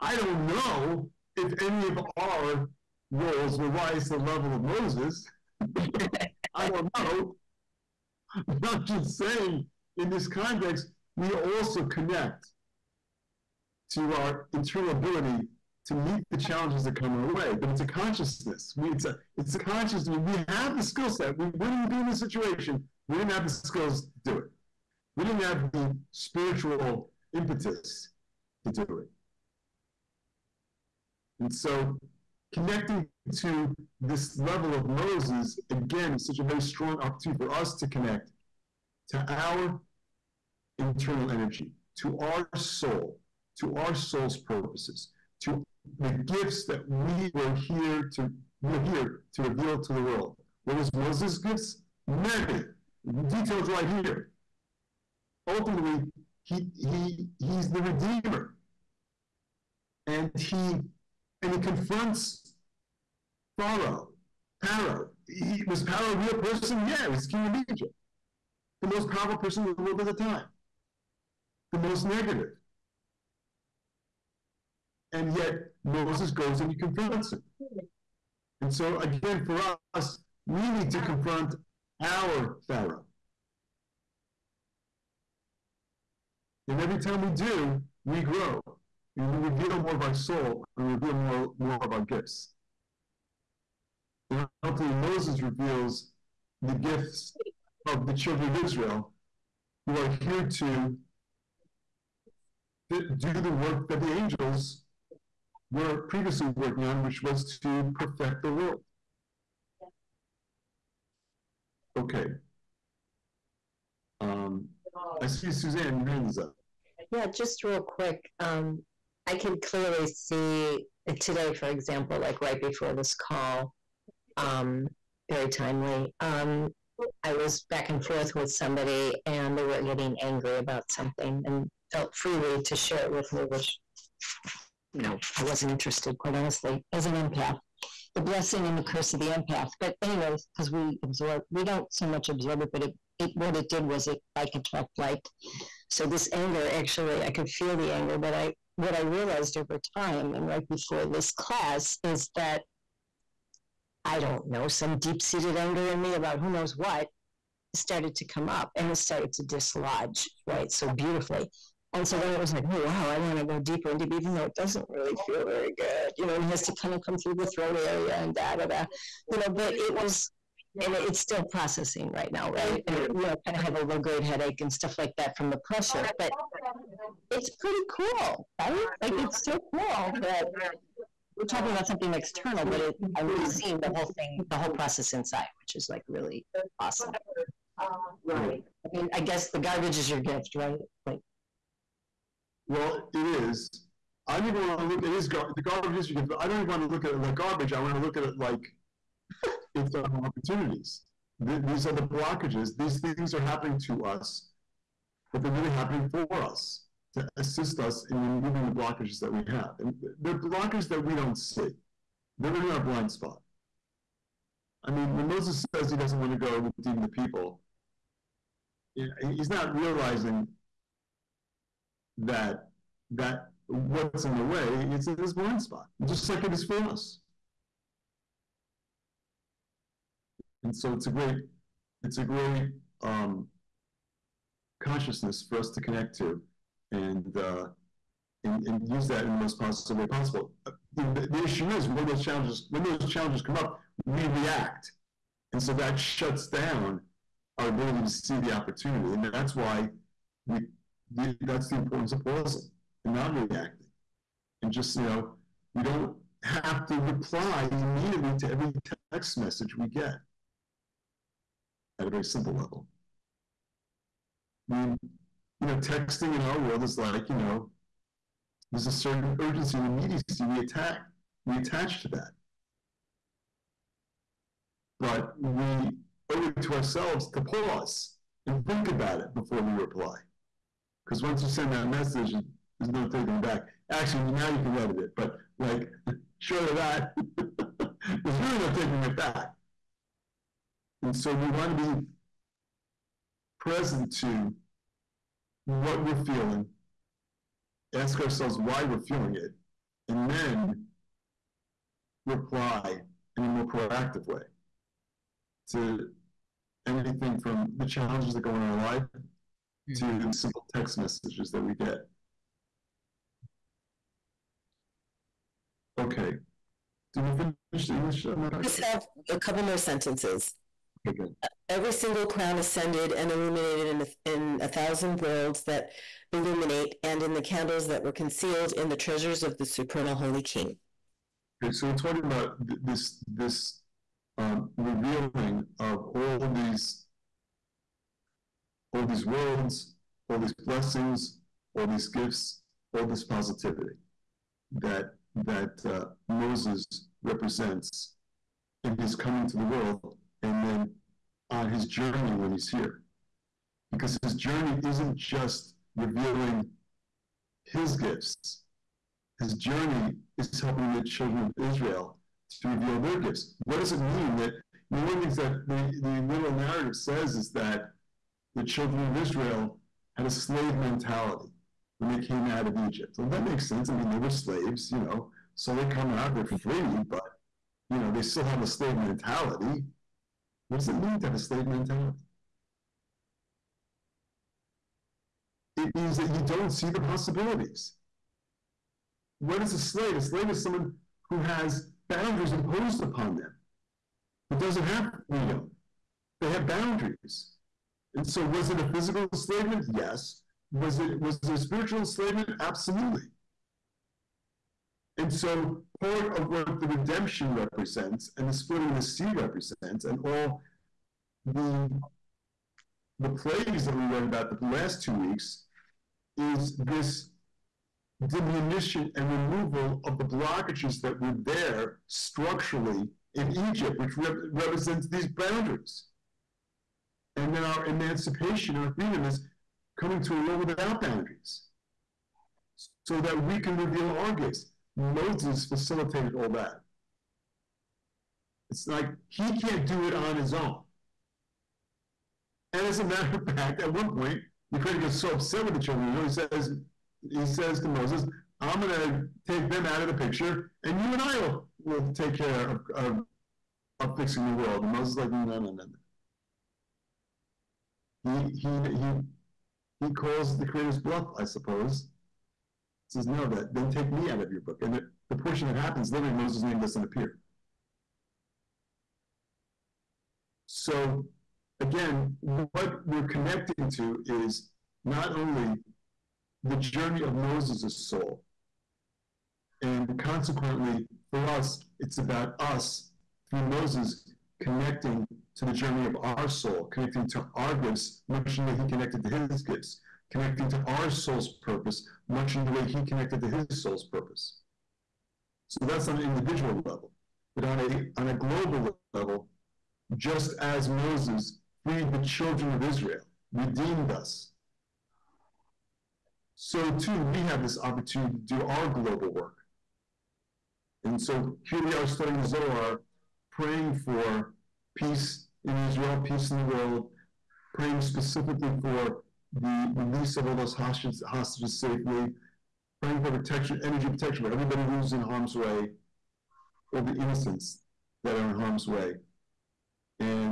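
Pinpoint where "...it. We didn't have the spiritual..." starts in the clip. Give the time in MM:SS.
00:24.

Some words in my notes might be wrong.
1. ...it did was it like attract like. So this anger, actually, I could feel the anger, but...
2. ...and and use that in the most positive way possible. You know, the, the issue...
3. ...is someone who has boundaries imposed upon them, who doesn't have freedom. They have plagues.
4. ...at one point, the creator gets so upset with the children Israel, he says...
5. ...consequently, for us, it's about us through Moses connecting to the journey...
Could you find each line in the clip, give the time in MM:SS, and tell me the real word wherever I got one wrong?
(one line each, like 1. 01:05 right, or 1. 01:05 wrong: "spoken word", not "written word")
1. 02:23 right
2. 03:58 right
3. 06:30 wrong: "boundaries", not "plagues"
4. 07:23 right
5. 08:00 right.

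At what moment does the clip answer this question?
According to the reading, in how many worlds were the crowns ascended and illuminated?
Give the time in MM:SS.
05:24.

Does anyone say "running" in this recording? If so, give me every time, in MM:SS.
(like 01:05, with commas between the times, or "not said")
not said.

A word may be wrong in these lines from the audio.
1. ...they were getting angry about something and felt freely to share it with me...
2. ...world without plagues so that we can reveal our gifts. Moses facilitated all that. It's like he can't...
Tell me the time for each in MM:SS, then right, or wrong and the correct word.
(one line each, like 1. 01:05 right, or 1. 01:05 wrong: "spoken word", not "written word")
1. 02:09 right
2. 07:10 wrong: "boundaries", not "plagues".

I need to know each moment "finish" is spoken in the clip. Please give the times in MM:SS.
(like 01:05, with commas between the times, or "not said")
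05:17.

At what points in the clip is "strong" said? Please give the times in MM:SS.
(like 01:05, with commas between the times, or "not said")
00:36.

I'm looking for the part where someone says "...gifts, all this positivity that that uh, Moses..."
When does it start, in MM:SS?
05:42.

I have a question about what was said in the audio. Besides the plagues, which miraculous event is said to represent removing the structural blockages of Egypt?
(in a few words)
splitting of the sea.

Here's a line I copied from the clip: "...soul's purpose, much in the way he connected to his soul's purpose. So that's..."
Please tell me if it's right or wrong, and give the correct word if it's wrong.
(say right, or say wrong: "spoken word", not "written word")
right.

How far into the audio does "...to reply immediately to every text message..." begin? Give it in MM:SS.
04:16.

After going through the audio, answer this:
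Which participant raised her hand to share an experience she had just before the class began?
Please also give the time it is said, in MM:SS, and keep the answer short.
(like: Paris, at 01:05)
Suzanne, at 01:55.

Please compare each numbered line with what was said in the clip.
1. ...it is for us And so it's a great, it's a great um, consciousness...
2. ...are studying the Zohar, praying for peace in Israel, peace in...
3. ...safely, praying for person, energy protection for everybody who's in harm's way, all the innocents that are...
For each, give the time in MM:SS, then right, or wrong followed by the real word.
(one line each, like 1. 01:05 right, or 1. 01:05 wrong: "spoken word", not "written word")
1. 03:46 right
2. 08:31 right
3. 08:41 wrong: "protection", not "person".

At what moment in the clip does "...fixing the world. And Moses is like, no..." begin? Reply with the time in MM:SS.
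07:34.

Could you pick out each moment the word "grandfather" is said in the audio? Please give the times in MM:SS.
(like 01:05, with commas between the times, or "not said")
not said.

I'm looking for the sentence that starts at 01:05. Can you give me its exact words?
He, was Pharaoh a real person?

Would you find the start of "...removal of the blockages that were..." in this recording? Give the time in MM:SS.
06:59.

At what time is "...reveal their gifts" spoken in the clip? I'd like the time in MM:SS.
06:02.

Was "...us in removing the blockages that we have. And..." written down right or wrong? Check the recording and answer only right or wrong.
right.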